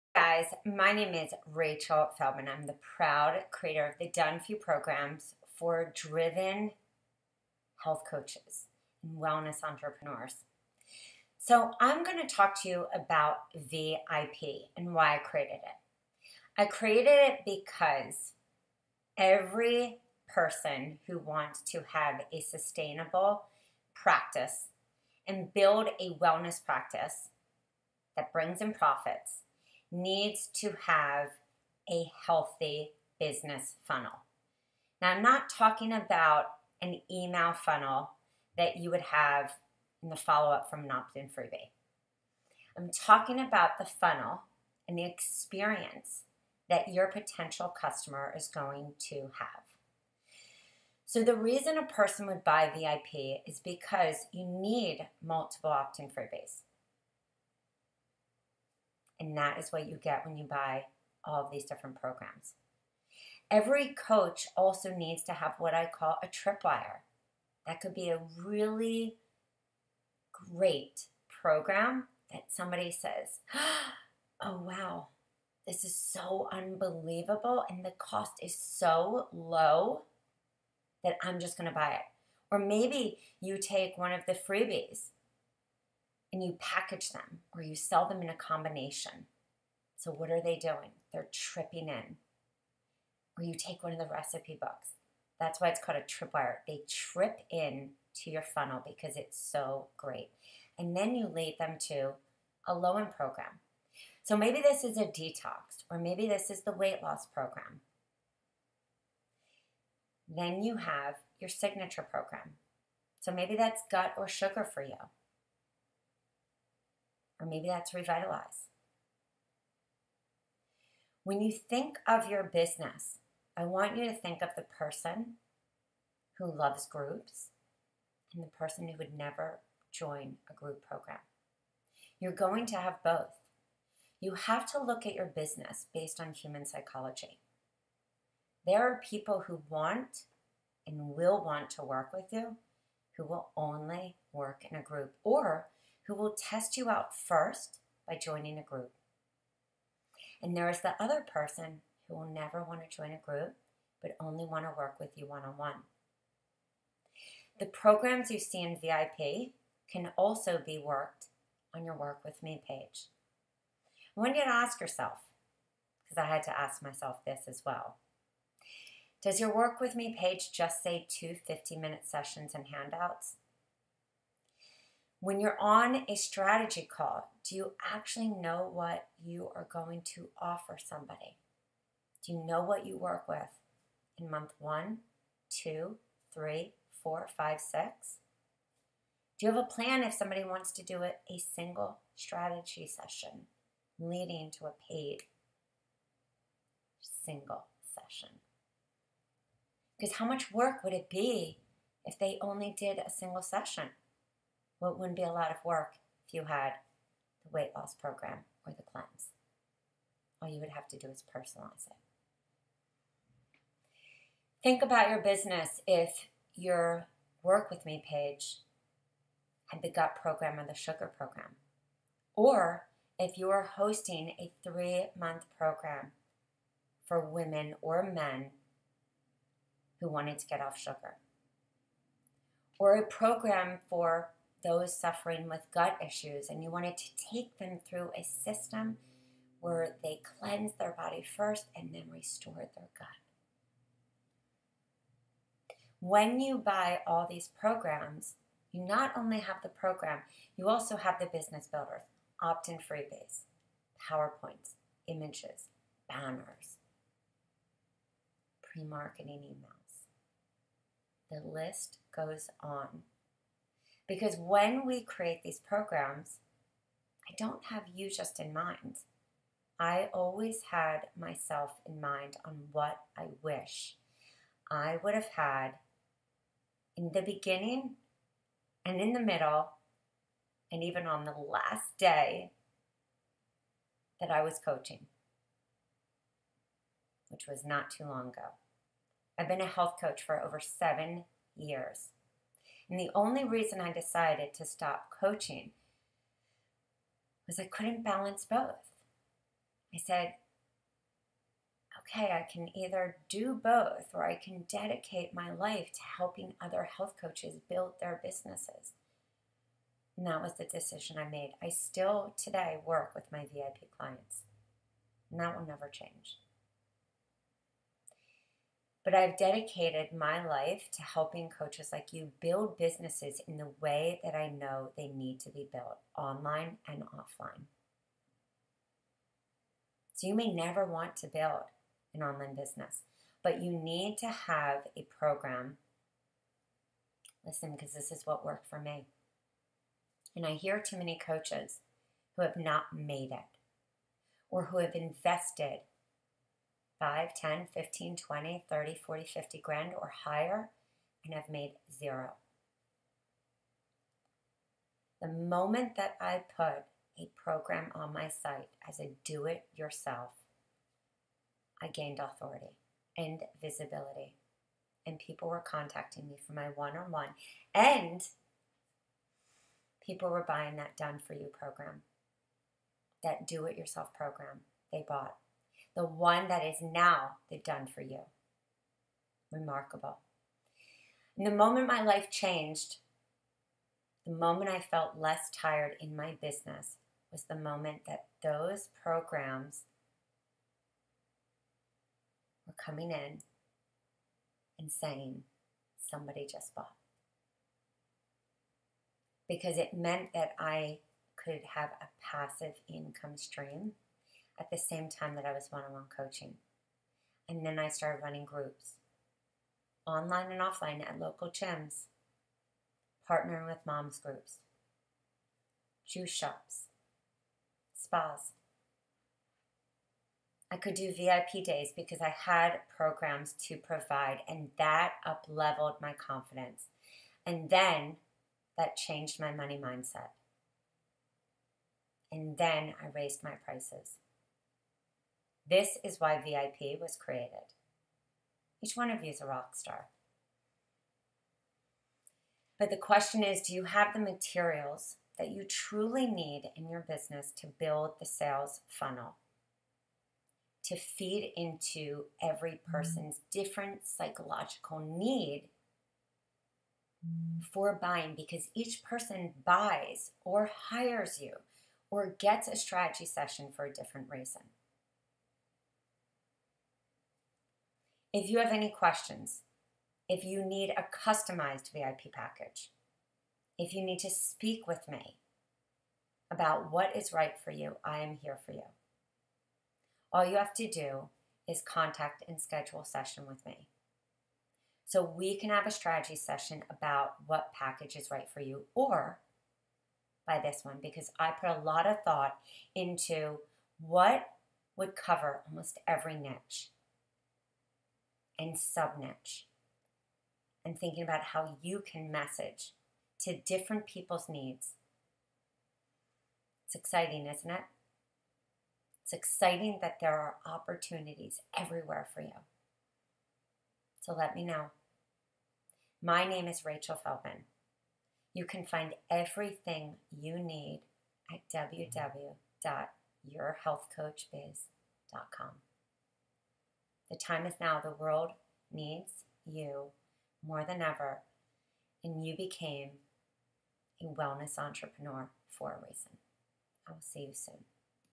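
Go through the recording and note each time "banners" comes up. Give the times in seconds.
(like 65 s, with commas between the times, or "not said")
256 s.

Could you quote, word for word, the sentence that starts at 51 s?
So, the reason a person would buy VIP is because you need multiple opt in freebies.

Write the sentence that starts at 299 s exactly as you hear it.
I said, okay, I can either do both or I can dedicate my life to helping other health coaches build their businesses.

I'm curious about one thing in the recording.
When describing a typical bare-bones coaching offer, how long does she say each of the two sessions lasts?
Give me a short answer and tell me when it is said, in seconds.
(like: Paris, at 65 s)
50 minutes, at 171 s.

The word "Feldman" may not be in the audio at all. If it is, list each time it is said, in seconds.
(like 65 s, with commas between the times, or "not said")
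2 s, 517 s.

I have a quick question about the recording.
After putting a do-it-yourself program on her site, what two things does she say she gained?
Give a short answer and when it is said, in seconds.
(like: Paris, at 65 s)
authority and visibility, at 362 s.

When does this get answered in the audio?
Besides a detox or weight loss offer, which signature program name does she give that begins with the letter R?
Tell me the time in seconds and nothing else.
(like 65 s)
117 s.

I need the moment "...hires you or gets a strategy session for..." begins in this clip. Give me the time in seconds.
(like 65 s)
460 s.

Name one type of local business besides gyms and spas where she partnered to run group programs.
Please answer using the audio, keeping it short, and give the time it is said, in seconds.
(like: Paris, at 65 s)
juice shops, at 416 s.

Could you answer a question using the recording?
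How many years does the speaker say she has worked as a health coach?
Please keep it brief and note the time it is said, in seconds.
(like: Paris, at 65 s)
over 7 years, at 290 s.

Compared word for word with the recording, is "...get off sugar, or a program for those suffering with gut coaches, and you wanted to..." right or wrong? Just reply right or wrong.
wrong.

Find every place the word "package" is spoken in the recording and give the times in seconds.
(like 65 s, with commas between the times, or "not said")
86 s, 472 s, 487 s.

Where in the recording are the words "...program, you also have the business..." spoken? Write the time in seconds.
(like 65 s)
249 s.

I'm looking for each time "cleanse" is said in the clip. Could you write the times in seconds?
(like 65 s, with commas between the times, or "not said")
208 s, 240 s.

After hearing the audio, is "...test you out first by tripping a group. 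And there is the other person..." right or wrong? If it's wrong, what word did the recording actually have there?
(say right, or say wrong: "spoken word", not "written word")
wrong: "joining", not "tripping".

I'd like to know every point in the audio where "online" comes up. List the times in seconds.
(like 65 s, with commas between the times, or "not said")
326 s, 332 s, 410 s.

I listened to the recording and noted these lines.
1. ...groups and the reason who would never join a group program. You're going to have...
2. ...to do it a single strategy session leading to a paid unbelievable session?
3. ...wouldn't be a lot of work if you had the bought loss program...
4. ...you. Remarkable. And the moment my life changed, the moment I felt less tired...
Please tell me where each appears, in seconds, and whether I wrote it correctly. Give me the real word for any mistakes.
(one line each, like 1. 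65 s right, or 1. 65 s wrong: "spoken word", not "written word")
1. 126 s wrong: "person", not "reason"
2. 190 s wrong: "single", not "unbelievable"
3. 204 s wrong: "weight", not "bought"
4. 378 s right.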